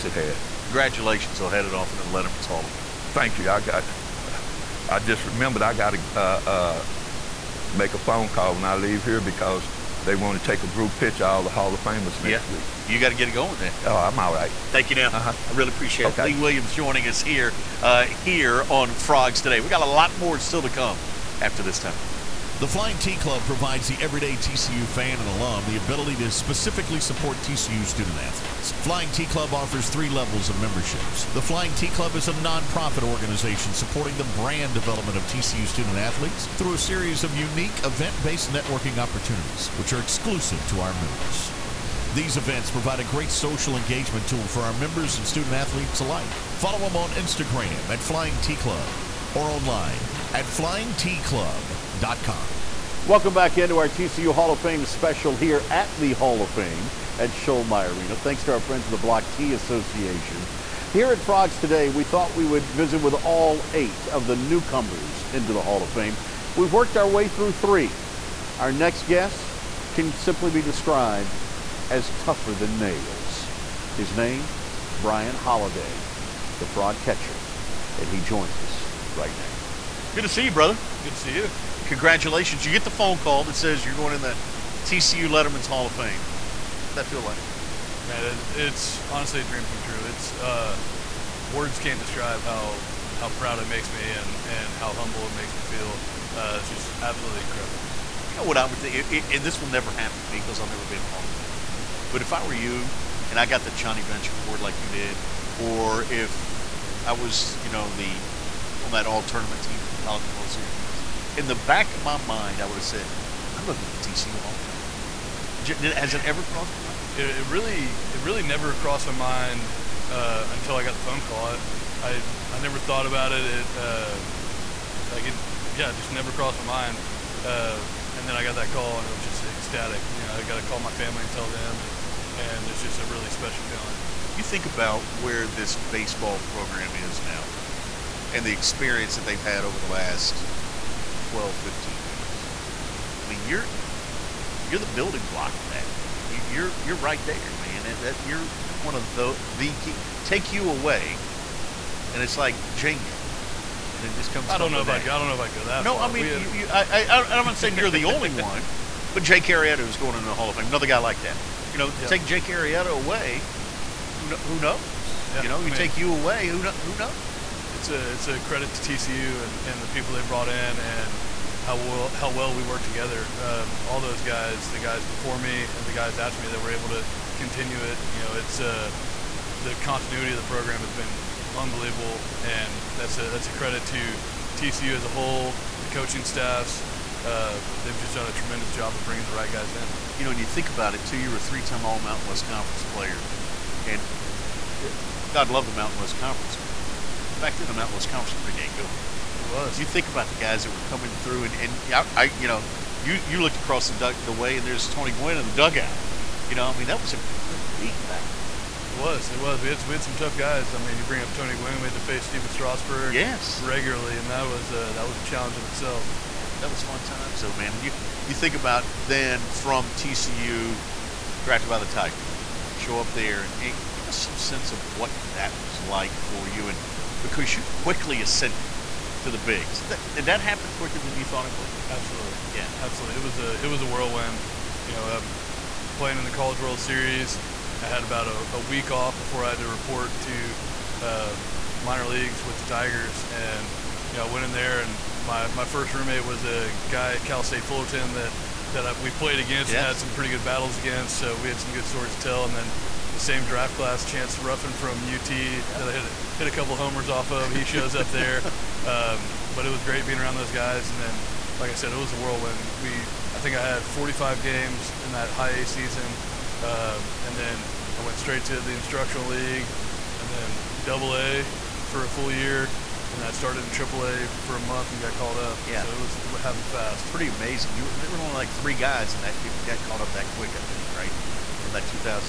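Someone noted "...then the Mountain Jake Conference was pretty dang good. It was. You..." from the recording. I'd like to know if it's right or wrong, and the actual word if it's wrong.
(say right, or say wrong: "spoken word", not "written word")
wrong: "West", not "Jake".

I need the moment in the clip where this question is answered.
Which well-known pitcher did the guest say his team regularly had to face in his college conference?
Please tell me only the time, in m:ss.
3:32.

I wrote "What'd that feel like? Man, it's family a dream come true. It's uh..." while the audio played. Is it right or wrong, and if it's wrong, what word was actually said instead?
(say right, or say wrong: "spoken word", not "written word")
wrong: "honestly", not "family".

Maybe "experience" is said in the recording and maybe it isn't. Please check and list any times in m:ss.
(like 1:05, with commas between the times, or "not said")
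2:18.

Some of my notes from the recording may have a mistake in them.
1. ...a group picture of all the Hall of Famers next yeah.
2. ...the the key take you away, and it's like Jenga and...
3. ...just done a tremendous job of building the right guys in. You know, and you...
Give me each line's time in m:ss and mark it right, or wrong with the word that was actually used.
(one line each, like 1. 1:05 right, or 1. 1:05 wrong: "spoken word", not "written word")
1. 0:10 right
2. 2:29 right
3. 3:07 wrong: "bringing", not "building".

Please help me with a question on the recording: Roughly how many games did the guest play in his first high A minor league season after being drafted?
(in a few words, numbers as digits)
45.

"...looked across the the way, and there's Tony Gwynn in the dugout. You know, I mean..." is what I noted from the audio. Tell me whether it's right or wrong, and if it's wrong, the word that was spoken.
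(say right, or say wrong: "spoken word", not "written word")
right.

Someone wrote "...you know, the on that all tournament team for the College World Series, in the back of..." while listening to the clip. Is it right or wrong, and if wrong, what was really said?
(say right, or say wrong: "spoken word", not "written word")
right.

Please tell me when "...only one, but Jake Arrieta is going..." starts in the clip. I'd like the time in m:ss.
2:38.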